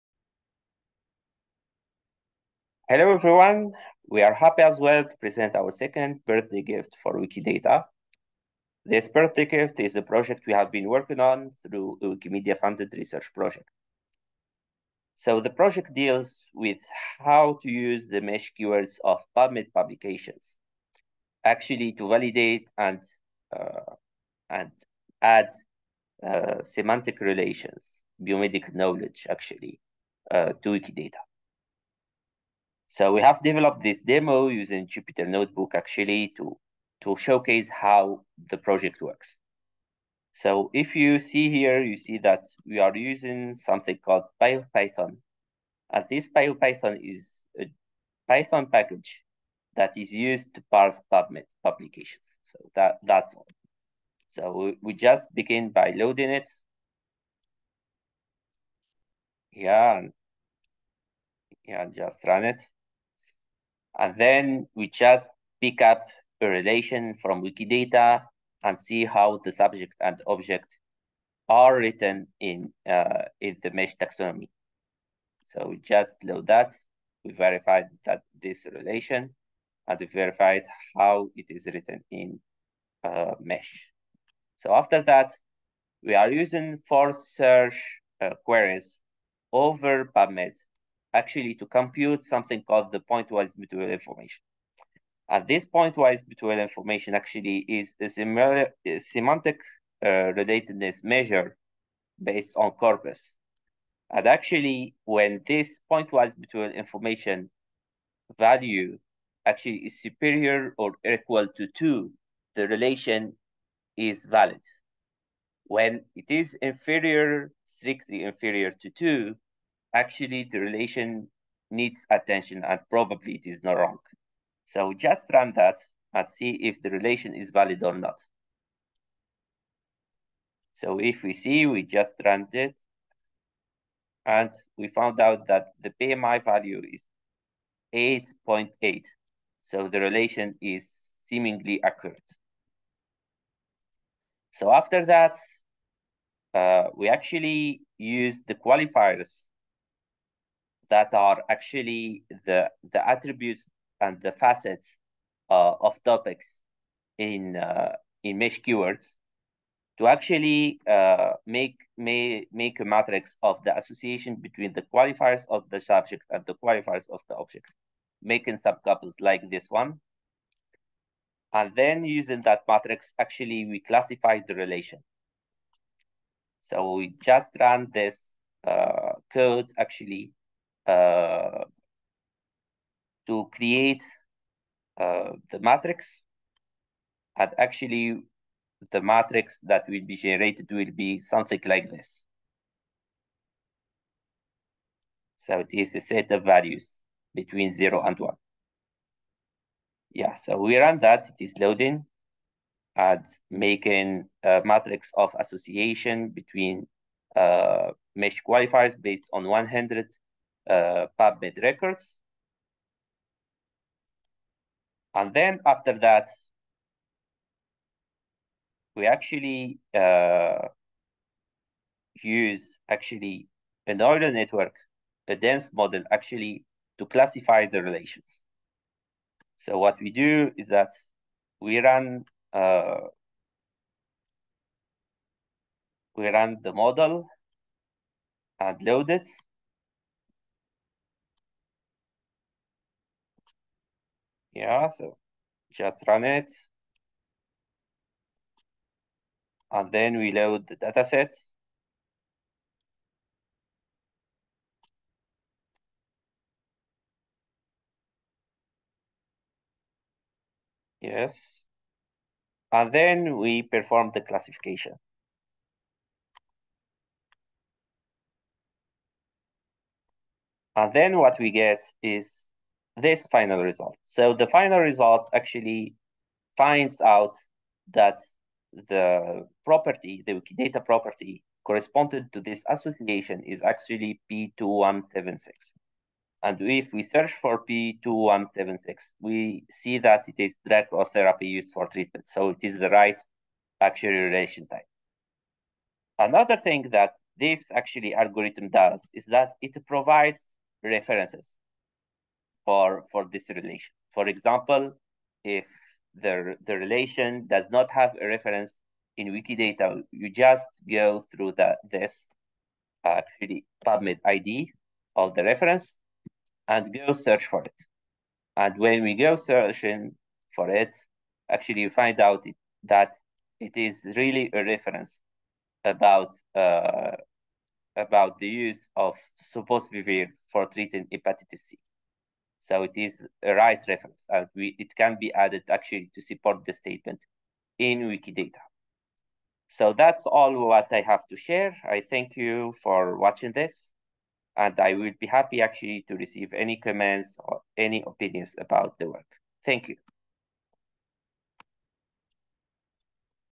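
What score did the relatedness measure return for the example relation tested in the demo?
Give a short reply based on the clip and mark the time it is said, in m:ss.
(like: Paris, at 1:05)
8.8, at 2:17.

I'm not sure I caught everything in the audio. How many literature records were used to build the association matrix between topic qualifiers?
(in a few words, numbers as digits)
100.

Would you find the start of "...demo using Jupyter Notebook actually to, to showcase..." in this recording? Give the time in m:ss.
0:34.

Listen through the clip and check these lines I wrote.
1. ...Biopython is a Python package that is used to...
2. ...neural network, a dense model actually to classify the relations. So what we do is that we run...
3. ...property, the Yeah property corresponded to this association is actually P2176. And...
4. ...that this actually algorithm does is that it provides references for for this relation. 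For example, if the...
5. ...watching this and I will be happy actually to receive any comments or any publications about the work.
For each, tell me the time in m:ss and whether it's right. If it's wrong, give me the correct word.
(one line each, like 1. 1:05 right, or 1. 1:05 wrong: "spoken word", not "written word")
1. 0:46 right
2. 3:43 right
3. 4:39 wrong: "Wikidata", not "Yeah"
4. 4:56 right
5. 5:43 wrong: "opinions", not "publications".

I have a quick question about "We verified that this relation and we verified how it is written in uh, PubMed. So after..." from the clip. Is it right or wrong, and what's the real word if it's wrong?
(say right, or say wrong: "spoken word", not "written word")
wrong: "MeSH", not "PubMed".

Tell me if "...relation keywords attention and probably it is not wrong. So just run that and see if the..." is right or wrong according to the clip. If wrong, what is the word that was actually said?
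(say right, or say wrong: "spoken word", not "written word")
wrong: "needs", not "keywords".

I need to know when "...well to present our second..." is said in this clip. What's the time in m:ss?
0:04.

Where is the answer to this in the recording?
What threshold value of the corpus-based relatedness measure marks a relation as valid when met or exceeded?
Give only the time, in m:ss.
1:50.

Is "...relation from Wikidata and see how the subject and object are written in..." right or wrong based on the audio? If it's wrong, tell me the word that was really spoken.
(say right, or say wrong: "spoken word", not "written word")
right.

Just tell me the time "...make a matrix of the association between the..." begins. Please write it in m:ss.
2:42.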